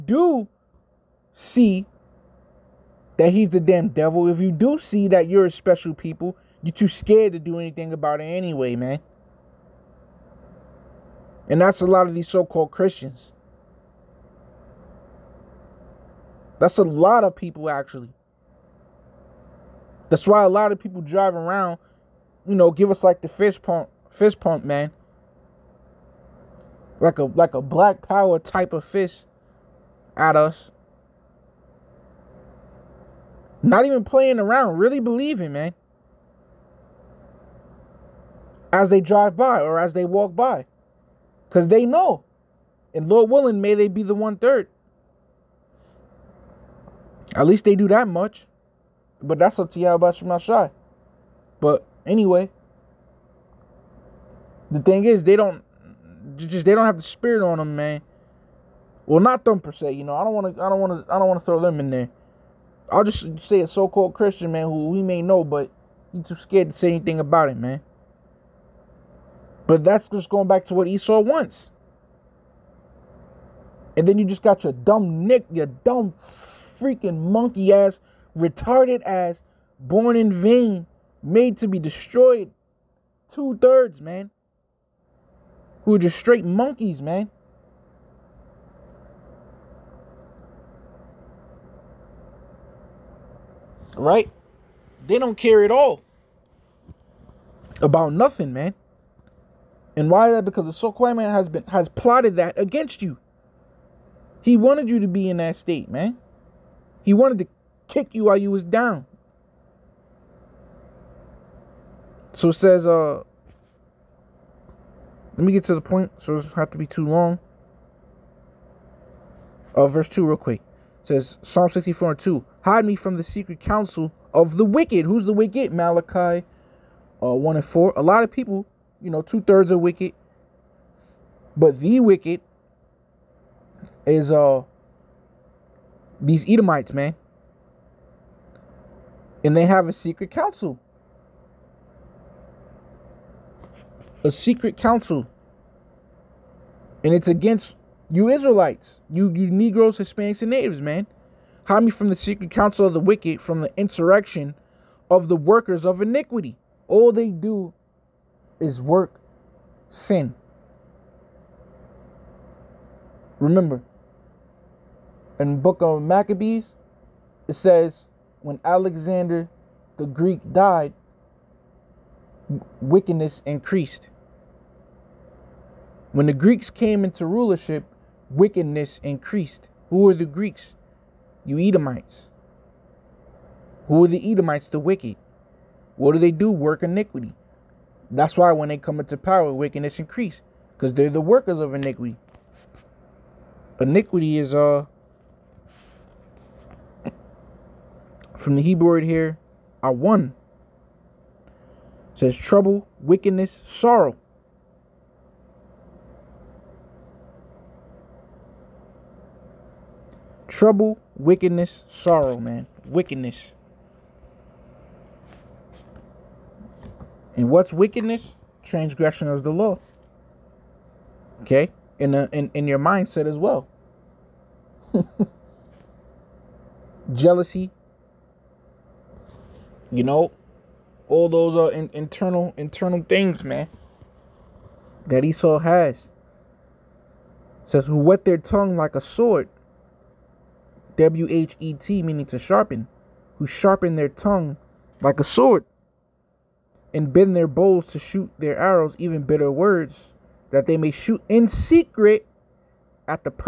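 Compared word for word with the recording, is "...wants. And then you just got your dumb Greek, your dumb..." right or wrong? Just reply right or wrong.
wrong.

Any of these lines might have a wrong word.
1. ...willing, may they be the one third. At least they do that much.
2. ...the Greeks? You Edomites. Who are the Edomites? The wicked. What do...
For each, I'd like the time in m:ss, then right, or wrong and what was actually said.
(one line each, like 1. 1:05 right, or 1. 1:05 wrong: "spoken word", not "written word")
1. 0:43 right
2. 3:00 right.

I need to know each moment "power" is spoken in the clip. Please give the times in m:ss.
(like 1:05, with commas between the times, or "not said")
0:28, 3:09.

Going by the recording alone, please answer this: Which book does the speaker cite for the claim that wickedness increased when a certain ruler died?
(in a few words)
Maccabees.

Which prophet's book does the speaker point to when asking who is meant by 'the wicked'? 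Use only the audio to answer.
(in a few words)
Malachi.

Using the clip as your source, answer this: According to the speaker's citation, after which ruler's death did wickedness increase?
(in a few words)
Alexander the Greek.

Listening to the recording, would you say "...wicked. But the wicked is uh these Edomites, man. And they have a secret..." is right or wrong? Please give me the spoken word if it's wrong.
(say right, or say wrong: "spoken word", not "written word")
right.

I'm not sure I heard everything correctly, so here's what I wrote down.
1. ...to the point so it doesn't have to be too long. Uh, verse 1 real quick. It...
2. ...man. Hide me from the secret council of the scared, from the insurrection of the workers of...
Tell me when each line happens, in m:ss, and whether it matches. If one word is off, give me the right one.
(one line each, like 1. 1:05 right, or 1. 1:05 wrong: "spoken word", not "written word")
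1. 1:55 wrong: "2", not "1"
2. 2:30 wrong: "wicked", not "scared".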